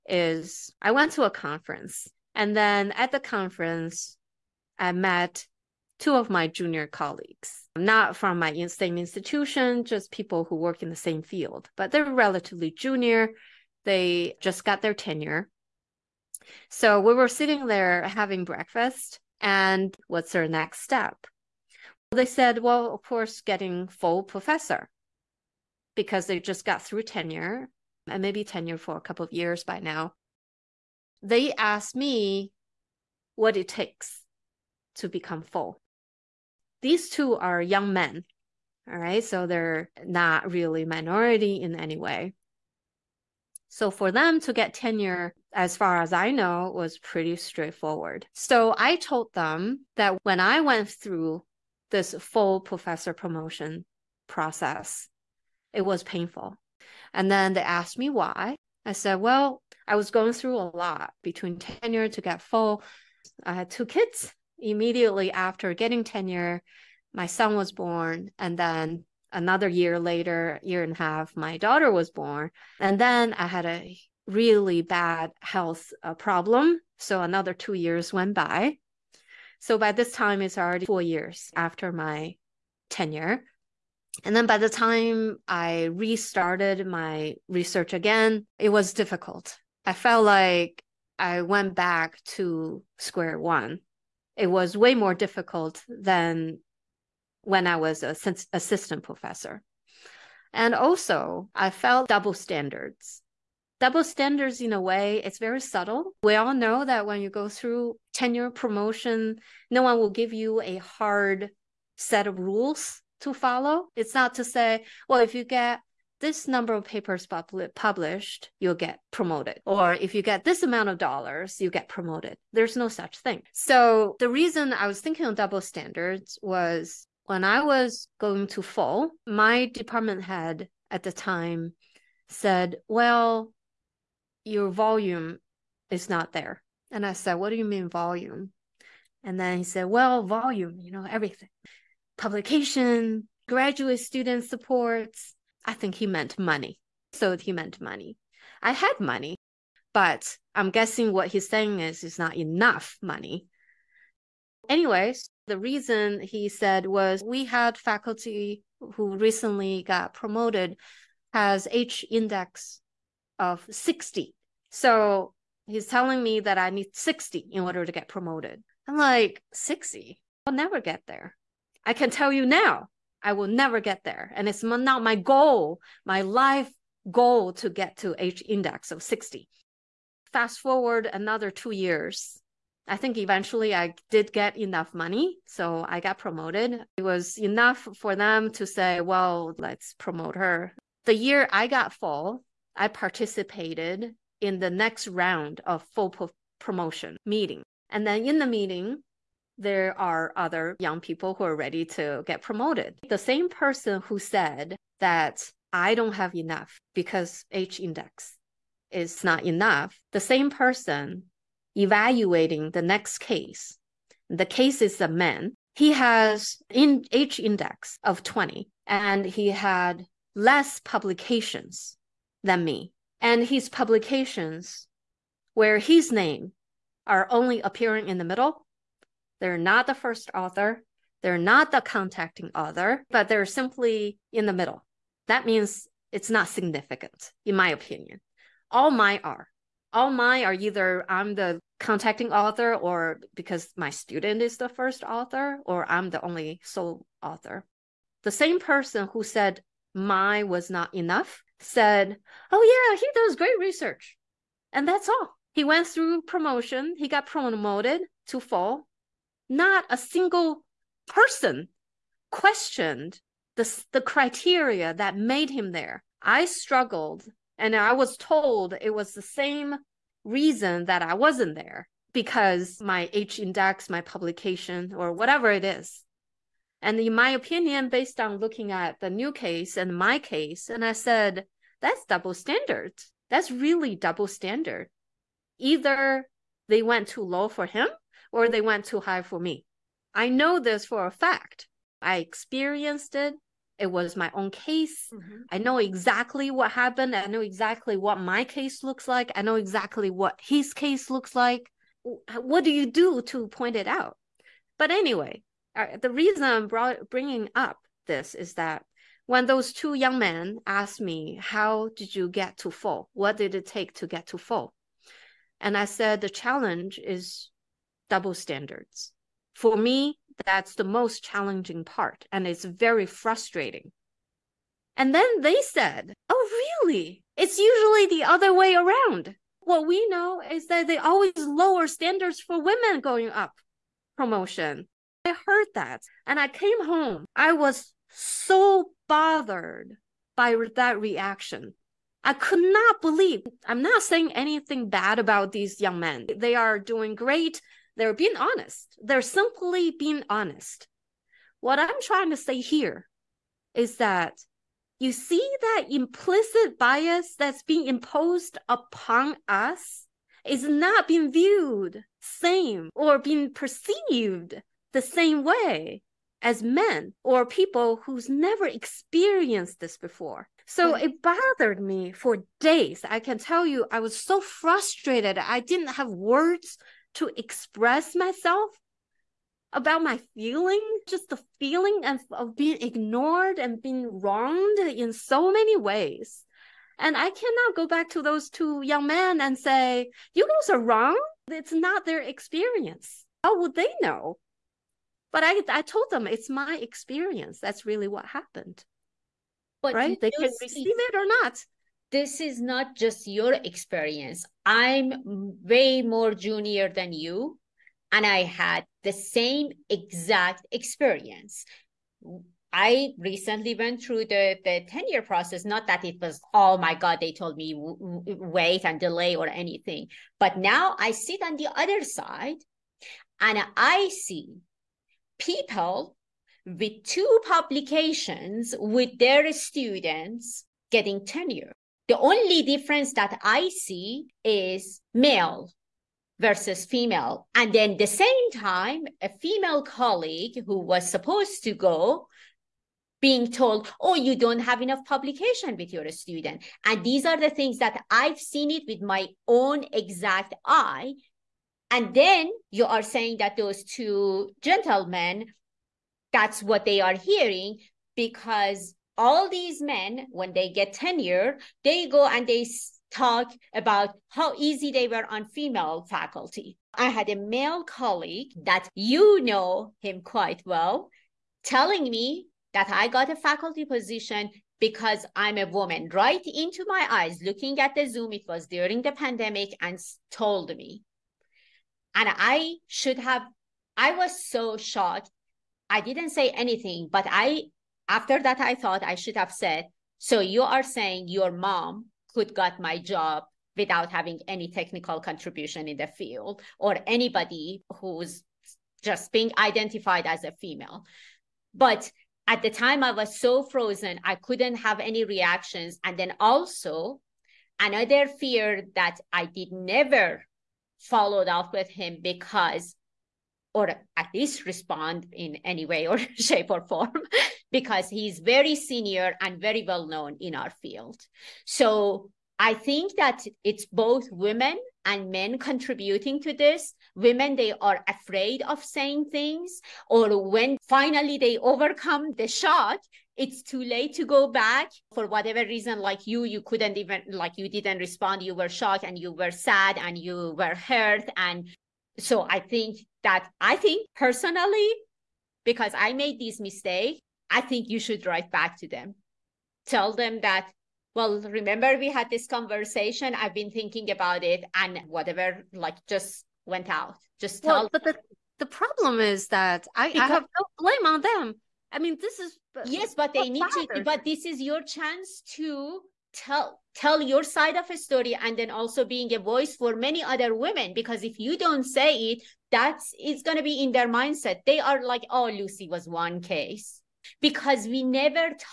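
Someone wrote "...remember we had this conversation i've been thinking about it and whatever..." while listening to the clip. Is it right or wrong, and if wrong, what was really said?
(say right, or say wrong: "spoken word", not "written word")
right.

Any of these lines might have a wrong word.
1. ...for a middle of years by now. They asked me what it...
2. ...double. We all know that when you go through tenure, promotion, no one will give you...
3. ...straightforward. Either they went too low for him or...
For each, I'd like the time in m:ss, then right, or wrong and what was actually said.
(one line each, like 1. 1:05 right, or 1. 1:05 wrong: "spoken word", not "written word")
1. 0:28 wrong: "couple", not "middle"
2. 1:45 wrong: "subtle", not "double"
3. 4:44 wrong: "standard", not "straightforward".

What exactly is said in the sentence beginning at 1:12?
And then I had a really bad health uh, problem.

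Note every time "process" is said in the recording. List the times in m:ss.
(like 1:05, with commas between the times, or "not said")
0:54, 6:55.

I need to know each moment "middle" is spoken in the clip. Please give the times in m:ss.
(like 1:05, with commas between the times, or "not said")
3:48, 3:54.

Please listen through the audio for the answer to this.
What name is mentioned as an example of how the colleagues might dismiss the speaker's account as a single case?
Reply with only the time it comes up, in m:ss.
9:35.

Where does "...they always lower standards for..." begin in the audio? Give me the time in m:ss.
5:30.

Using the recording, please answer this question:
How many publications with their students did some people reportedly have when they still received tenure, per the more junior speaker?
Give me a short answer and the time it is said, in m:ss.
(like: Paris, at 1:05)
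2, at 7:07.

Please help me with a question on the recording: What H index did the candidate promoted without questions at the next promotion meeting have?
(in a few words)
20.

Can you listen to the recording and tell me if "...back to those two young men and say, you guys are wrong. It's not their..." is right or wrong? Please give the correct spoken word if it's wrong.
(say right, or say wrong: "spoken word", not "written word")
right.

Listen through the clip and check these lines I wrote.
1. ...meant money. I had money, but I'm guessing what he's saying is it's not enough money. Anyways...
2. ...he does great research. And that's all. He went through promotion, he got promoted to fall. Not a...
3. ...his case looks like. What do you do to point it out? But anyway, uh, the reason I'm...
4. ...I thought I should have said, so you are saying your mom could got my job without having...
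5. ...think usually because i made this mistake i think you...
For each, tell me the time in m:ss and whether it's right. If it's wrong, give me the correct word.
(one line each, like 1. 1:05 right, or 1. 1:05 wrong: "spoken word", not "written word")
1. 2:27 right
2. 4:12 right
3. 5:00 right
4. 8:08 right
5. 9:03 wrong: "personally", not "usually".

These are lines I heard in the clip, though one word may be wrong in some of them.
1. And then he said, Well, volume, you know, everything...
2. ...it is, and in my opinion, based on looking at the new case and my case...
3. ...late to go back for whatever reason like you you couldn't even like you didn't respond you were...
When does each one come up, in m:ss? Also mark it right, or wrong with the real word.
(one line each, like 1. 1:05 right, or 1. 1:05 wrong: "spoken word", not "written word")
1. 2:19 right
2. 4:35 right
3. 8:53 right.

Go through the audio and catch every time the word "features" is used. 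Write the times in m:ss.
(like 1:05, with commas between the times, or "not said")
not said.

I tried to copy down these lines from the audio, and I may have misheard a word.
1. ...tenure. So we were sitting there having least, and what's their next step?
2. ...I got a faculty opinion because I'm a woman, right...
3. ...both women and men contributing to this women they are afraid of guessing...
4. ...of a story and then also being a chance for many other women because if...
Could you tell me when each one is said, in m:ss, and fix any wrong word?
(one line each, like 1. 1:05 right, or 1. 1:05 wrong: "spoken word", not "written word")
1. 0:14 wrong: "breakfast", not "least"
2. 7:52 wrong: "position", not "opinion"
3. 8:43 wrong: "saying", not "guessing"
4. 9:27 wrong: "voice", not "chance".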